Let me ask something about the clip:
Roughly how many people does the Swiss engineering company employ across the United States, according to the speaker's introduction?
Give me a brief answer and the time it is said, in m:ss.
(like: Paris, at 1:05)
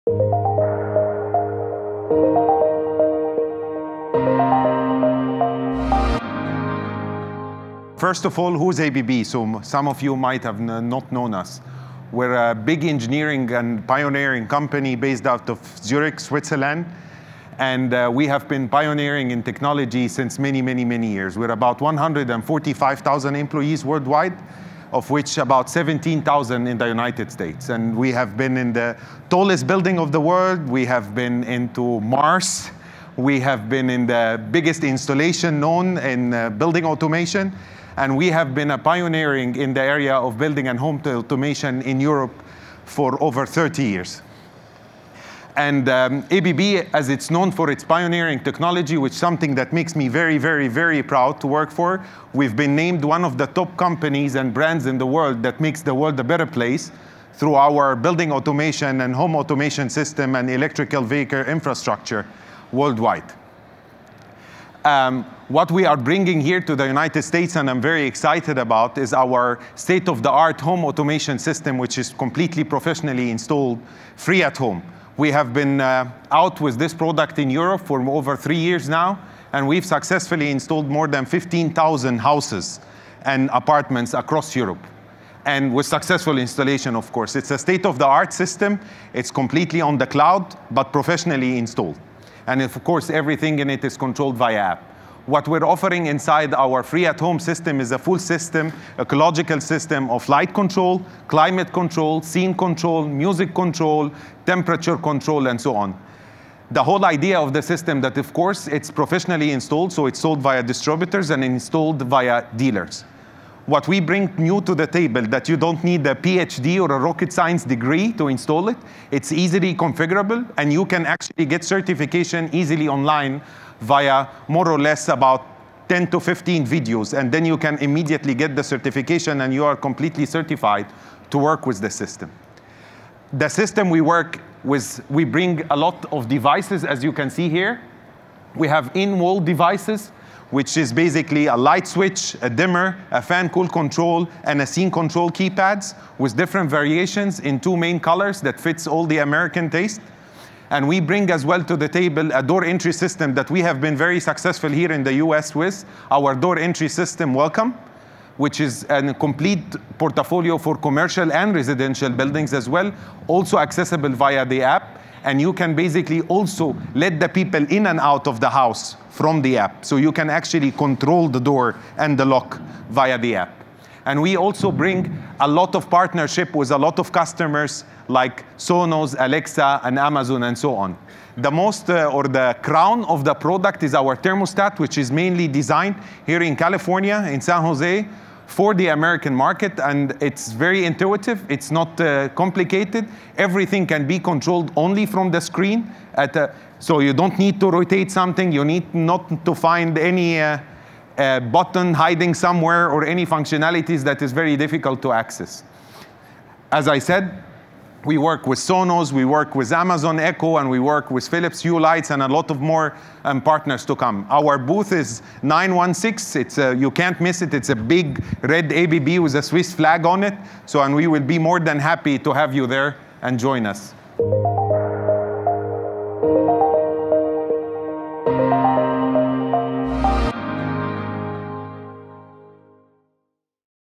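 17,000, at 0:25.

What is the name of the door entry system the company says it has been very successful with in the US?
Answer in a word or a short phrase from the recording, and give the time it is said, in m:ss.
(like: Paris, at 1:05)
Welcome, at 2:37.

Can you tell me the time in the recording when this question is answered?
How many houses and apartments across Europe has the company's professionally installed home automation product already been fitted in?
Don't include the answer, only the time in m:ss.
1:20.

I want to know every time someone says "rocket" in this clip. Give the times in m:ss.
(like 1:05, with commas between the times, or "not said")
1:56.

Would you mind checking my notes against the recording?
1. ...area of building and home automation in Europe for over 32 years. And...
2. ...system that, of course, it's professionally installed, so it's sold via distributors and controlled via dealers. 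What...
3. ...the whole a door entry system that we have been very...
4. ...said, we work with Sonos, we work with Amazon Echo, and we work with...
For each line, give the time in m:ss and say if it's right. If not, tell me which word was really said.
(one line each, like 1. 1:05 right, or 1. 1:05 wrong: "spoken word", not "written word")
1. 0:39 wrong: "30", not "32"
2. 1:47 wrong: "installed", not "controlled"
3. 2:31 wrong: "table", not "whole"
4. 3:26 right.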